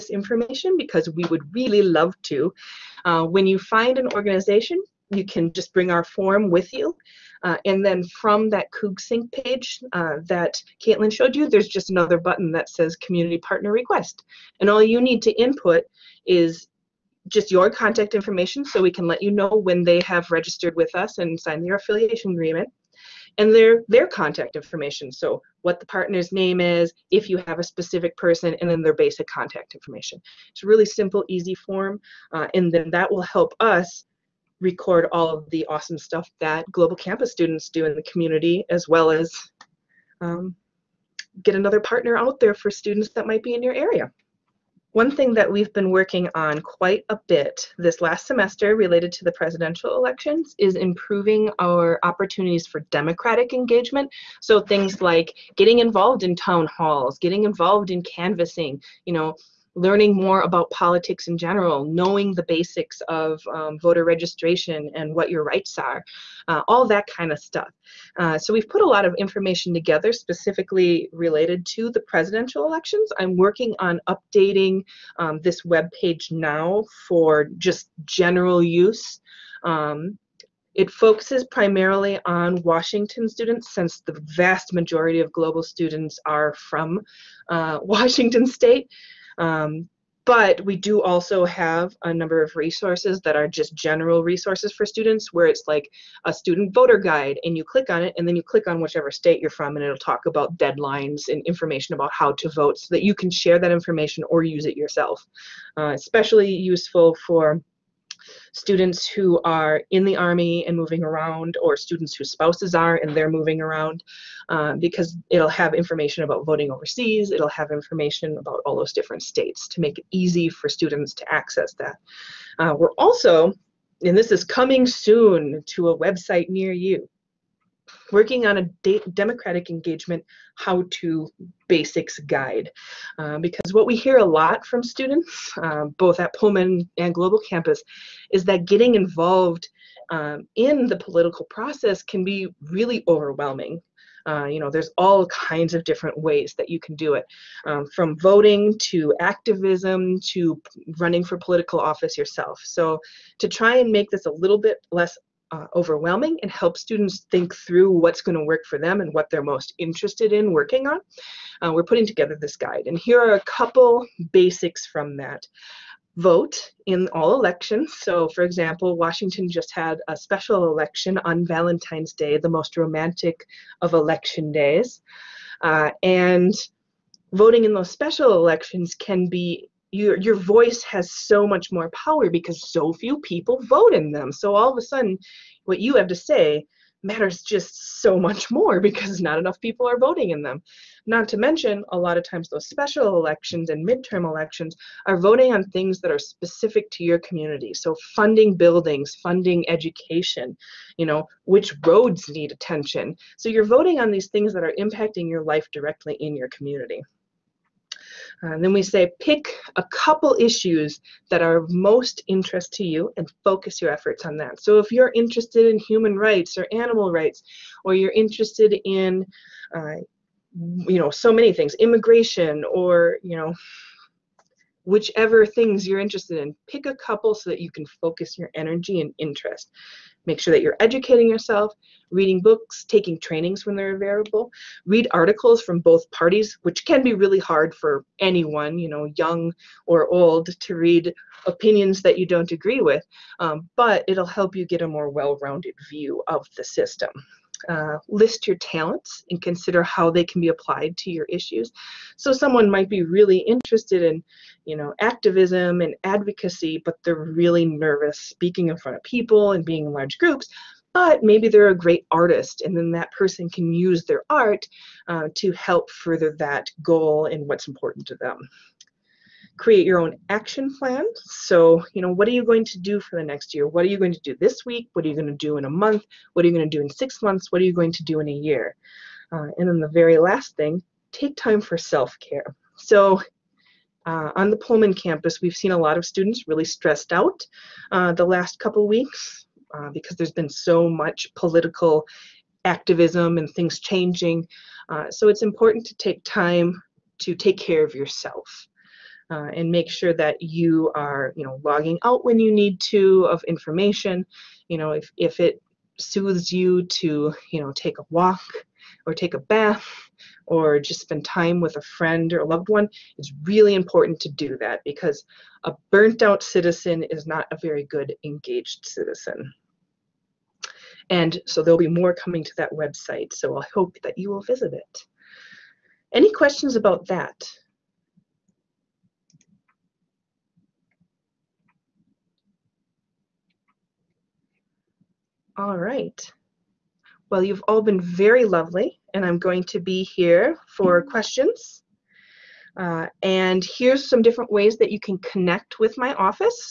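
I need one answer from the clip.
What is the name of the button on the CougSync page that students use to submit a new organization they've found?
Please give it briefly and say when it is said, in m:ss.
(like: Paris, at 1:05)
Community Partner Request, at 0:12.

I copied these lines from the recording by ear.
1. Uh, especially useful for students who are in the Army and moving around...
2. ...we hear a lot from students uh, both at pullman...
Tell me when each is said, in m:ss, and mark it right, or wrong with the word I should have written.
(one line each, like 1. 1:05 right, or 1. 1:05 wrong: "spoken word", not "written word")
1. 1:45 right
2. 2:13 right.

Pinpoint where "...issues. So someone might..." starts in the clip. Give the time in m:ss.
4:11.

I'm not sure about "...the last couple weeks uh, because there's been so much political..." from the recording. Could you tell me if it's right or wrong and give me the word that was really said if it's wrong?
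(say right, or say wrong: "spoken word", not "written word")
right.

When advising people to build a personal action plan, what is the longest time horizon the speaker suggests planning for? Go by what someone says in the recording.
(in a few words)
a year.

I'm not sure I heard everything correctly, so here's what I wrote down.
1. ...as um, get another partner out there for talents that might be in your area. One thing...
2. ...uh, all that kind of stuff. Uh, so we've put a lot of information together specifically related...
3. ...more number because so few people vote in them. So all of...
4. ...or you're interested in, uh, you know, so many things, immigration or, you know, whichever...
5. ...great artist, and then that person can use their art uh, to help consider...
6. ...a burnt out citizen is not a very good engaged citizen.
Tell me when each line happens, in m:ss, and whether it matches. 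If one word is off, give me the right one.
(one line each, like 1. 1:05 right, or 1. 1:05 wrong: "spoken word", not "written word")
1. 0:39 wrong: "students", not "talents"
2. 1:06 right
3. 3:01 wrong: "power", not "number"
4. 3:37 right
5. 4:21 wrong: "further", not "consider"
6. 5:15 right.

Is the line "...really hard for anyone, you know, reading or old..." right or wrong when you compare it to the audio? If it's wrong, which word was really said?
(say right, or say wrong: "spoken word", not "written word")
wrong: "young", not "reading".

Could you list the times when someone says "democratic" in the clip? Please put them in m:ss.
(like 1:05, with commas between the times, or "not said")
0:52, 2:09.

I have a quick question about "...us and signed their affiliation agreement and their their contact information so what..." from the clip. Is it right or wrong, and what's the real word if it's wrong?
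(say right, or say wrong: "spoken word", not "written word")
right.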